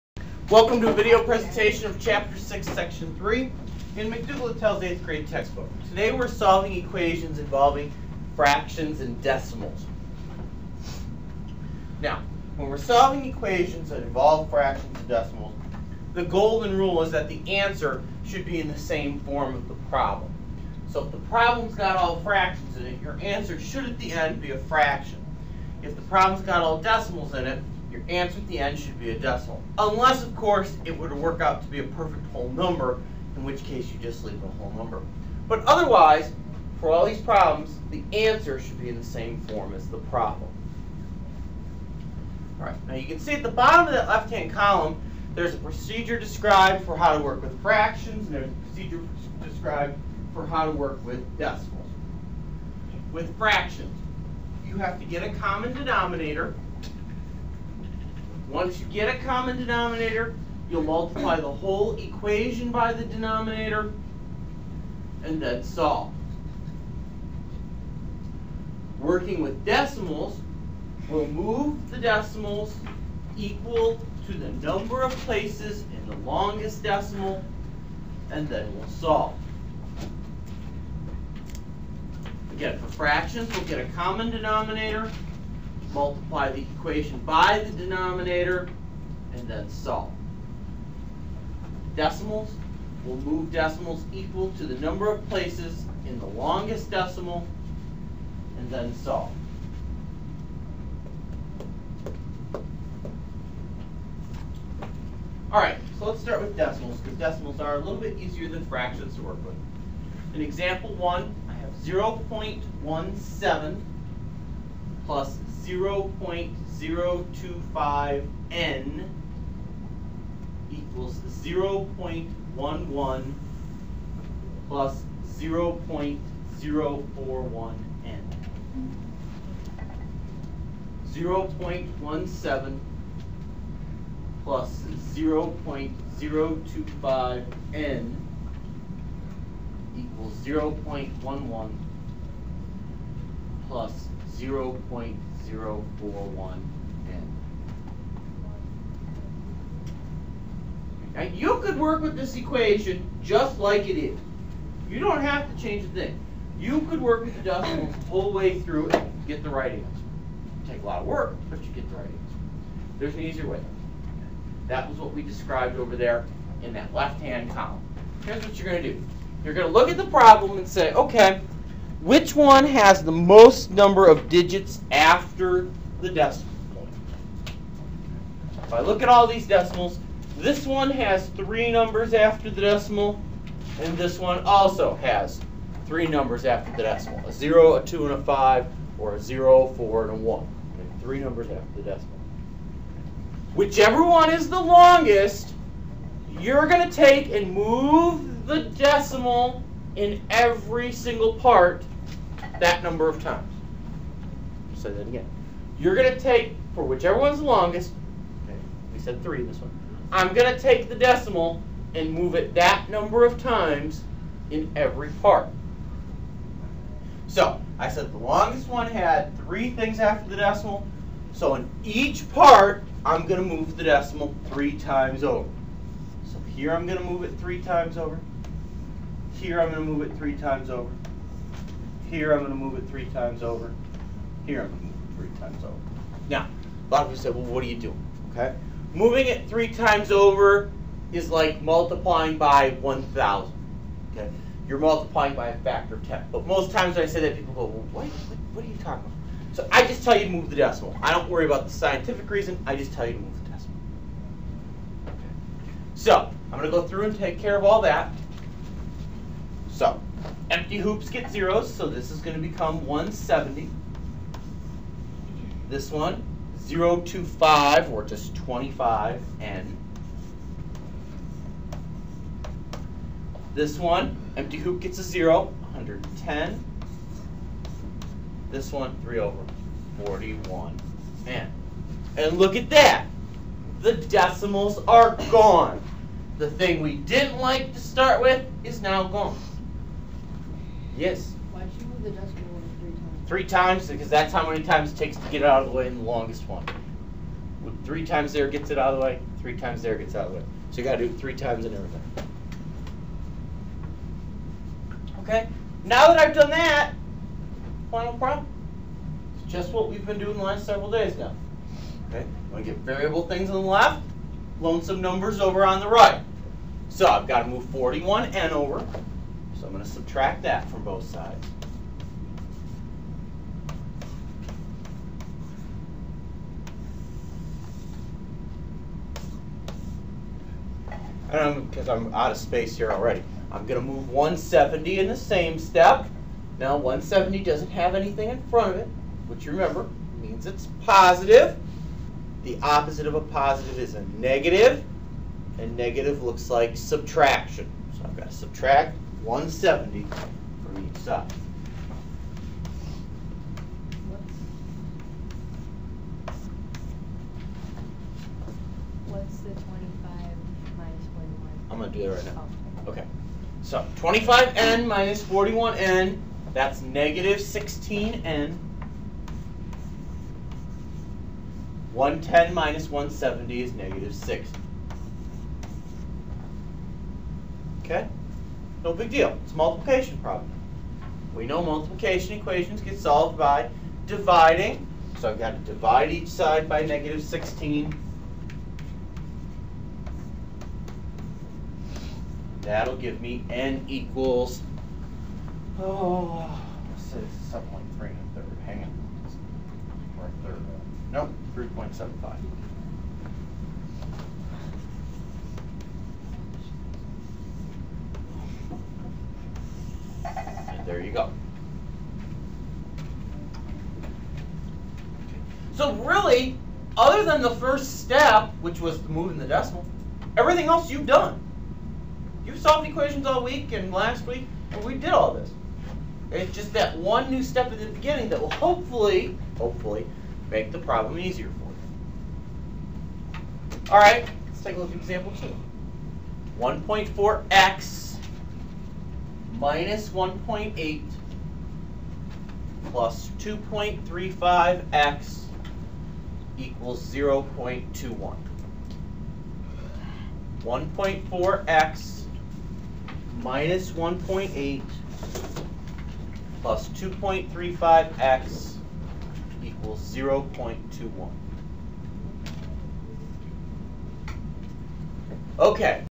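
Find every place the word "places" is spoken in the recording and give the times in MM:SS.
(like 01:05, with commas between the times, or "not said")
01:15, 01:35.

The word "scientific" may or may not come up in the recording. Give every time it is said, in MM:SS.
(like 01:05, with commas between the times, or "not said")
04:11.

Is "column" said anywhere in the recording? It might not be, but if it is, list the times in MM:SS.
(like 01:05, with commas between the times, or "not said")
00:44, 02:47.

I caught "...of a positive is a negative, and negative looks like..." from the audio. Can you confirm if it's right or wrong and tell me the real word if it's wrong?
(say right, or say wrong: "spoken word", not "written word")
right.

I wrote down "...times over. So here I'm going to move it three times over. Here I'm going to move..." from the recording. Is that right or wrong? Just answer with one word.
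right.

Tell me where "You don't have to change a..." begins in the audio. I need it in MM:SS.
02:34.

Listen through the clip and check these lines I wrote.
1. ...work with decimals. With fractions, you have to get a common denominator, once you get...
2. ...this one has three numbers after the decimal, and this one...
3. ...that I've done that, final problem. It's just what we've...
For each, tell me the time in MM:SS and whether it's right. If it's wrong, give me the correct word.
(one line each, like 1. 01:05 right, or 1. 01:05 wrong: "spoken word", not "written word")
1. 00:50 right
2. 03:00 right
3. 05:06 right.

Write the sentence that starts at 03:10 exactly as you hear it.
Okay, three numbers after the decimal.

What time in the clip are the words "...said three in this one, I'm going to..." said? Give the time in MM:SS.
03:28.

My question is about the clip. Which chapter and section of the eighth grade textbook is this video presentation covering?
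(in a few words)
Chapter 6, Section 3.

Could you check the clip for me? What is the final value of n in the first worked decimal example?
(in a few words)
3.75.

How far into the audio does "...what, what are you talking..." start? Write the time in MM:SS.
04:08.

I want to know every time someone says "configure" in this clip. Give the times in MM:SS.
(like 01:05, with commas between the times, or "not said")
not said.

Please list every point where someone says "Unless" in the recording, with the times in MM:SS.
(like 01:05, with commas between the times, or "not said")
00:29.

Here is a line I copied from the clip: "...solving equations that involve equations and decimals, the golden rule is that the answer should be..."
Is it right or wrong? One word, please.
wrong.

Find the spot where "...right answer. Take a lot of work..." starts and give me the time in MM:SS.
02:39.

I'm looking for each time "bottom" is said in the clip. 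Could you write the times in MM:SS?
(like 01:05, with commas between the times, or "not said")
00:43.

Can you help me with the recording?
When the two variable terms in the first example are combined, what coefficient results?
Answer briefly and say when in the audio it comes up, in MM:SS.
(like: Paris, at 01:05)
-16, at 06:06.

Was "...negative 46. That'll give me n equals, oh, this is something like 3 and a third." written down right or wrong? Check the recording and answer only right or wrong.
wrong.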